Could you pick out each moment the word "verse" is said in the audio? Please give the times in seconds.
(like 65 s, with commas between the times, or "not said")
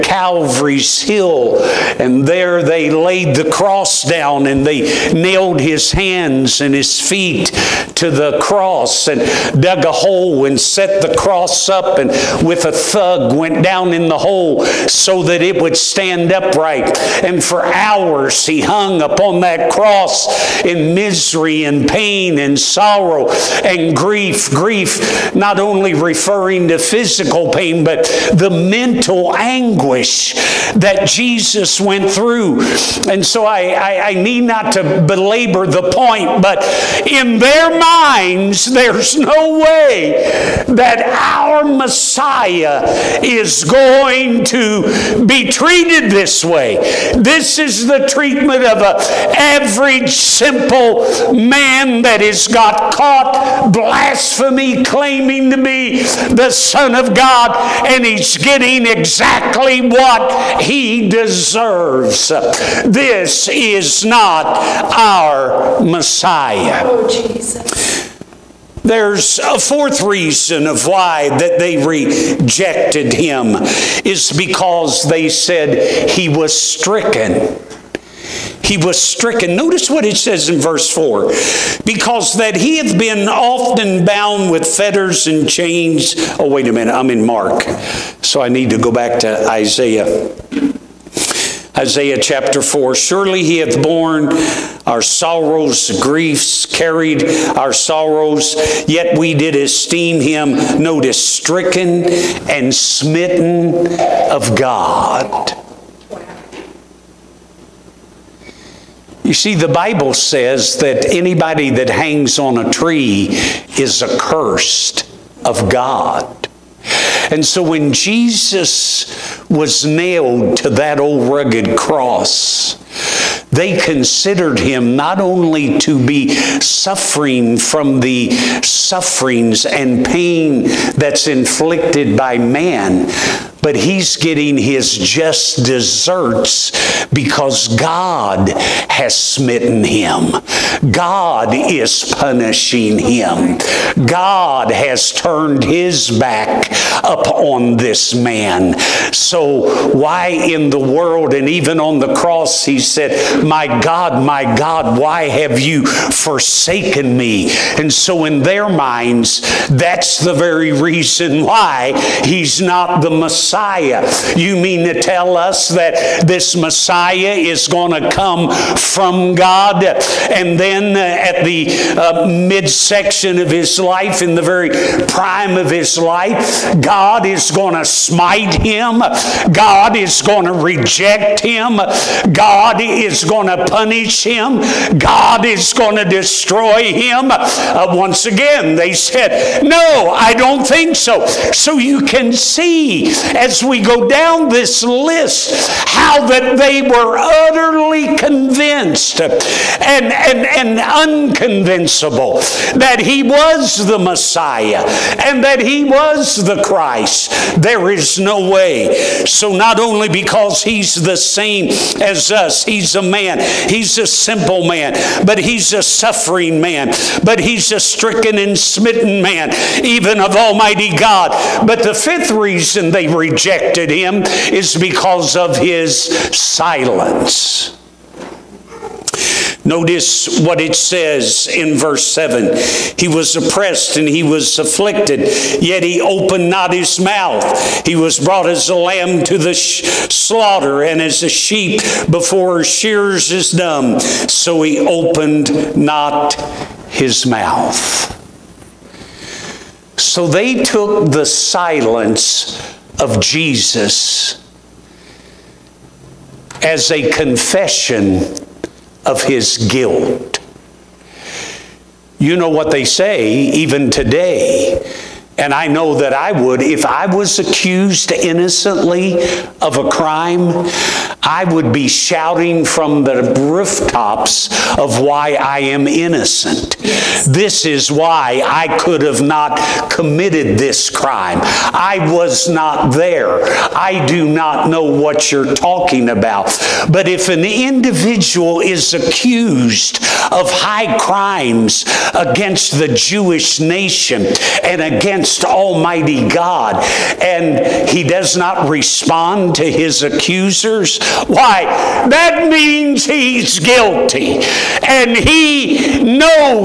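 80 s, 231 s.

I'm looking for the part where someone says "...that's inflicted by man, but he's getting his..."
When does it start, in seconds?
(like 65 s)
130 s.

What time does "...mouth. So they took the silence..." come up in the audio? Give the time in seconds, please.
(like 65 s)
247 s.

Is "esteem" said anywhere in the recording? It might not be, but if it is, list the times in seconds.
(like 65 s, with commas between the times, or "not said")
99 s.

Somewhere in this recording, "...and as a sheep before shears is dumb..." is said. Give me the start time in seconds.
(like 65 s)
240 s.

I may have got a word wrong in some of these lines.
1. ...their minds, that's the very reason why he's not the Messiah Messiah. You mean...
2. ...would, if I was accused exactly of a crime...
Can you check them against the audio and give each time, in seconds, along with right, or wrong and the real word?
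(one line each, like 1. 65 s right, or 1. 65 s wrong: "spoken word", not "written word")
1. 158 s right
2. 266 s wrong: "innocently", not "exactly".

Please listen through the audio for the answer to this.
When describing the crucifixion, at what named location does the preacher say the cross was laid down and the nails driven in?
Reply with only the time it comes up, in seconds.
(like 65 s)
0 s.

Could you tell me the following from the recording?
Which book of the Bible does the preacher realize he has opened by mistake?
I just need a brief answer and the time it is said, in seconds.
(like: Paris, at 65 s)
Mark, at 87 s.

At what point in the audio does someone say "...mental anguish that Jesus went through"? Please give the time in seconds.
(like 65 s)
28 s.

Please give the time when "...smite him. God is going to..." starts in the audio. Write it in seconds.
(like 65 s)
177 s.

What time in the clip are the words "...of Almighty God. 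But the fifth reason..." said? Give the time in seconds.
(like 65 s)
220 s.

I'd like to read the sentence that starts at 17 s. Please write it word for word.
And for hours he hung upon that cross in misery and pain and sorrow and grief.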